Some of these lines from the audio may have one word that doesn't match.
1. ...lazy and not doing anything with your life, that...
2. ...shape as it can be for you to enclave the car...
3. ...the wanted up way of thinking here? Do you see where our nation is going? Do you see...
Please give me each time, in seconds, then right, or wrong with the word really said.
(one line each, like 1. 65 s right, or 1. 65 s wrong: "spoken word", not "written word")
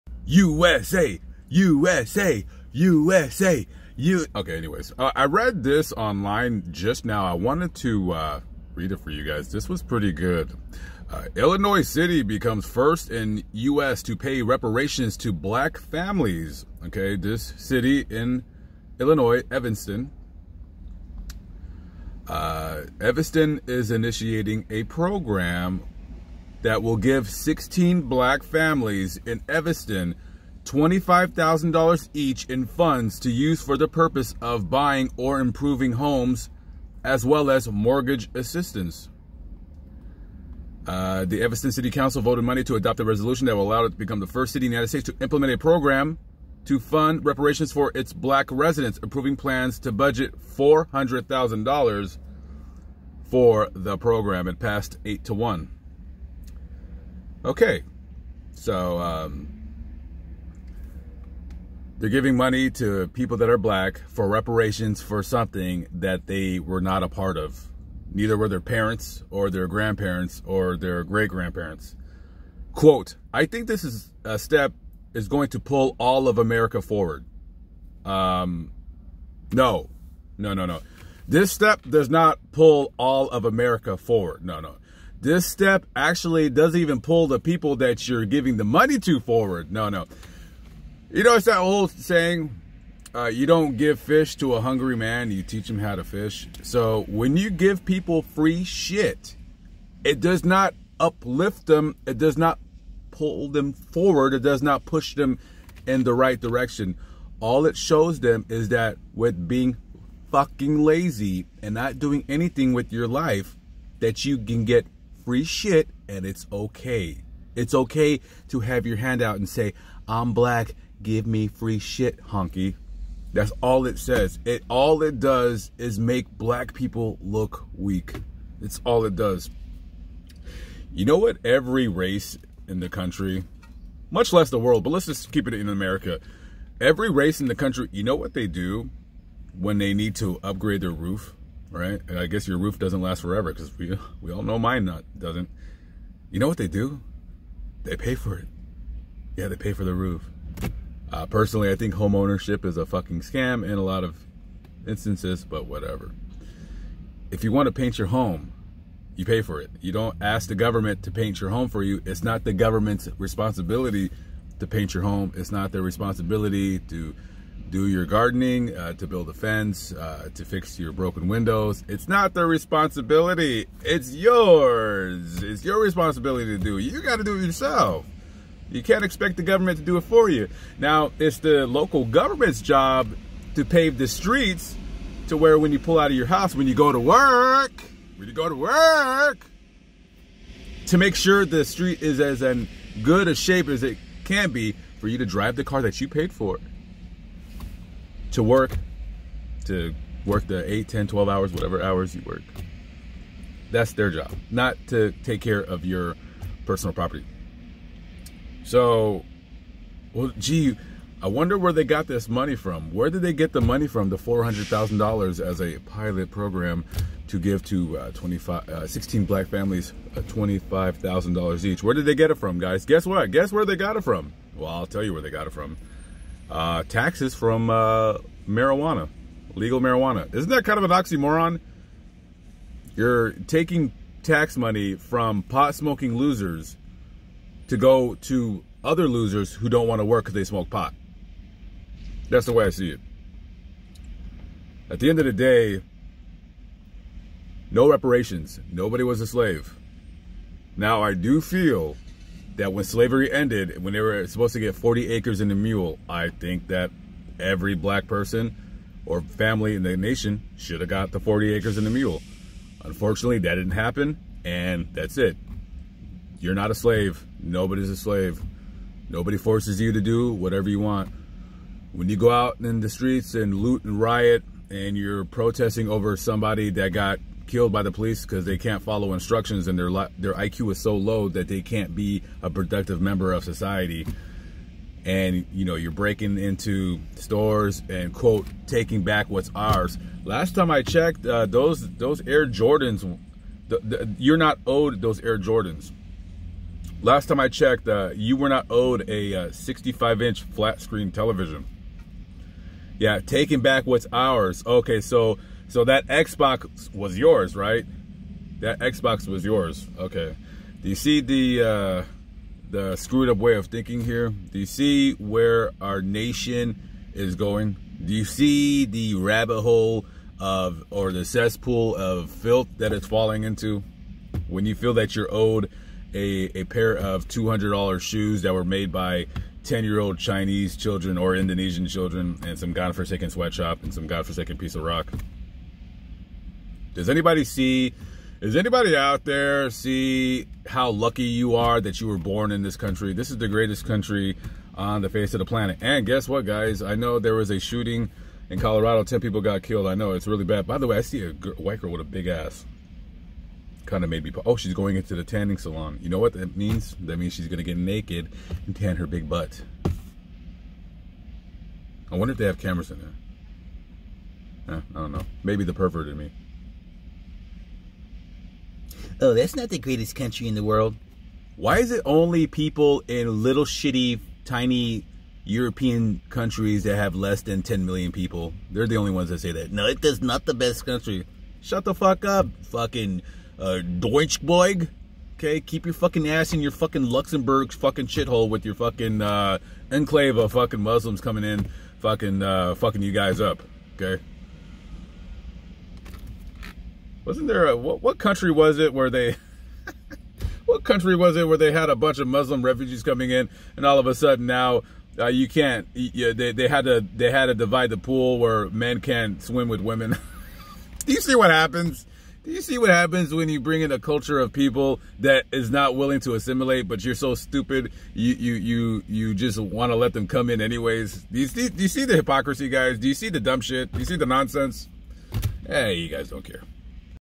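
1. 110 s right
2. 193 s wrong: "drive", not "enclave"
3. 312 s wrong: "screwed", not "wanted".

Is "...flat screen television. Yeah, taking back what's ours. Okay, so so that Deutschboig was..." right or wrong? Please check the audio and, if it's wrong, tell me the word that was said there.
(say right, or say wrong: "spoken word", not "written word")
wrong: "Xbox", not "Deutschboig".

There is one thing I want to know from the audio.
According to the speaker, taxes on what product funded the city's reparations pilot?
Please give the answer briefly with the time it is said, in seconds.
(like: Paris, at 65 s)
legal marijuana, at 229 s.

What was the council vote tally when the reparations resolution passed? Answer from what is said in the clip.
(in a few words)
8 to 1.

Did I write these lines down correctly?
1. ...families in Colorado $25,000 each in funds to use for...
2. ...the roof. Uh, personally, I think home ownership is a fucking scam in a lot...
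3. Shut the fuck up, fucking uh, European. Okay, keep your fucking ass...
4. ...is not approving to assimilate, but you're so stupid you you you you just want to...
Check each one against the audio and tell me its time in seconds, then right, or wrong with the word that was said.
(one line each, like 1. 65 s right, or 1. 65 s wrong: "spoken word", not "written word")
1. 28 s wrong: "Evanston", not "Colorado"
2. 149 s right
3. 381 s wrong: "Deutschboig", not "European"
4. 415 s wrong: "willing", not "approving".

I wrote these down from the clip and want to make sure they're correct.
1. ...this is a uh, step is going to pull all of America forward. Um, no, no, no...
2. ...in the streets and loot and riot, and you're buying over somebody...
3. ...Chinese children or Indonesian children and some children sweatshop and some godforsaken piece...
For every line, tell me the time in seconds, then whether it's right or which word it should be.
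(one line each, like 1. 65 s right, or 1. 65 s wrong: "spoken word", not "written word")
1. 73 s right
2. 272 s wrong: "protesting", not "buying"
3. 330 s wrong: "godforsaken", not "children".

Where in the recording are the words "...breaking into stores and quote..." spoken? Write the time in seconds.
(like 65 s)
285 s.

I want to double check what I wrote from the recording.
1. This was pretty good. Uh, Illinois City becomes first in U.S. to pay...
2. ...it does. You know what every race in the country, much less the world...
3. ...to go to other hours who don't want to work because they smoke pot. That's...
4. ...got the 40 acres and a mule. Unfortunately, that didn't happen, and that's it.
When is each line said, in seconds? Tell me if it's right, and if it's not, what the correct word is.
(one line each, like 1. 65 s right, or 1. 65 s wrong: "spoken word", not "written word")
1. 9 s right
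2. 129 s right
3. 237 s wrong: "losers", not "hours"
4. 260 s right.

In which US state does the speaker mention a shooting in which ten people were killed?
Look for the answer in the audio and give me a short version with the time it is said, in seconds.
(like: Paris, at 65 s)
Colorado, at 348 s.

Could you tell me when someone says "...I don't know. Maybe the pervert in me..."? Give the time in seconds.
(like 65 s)
364 s.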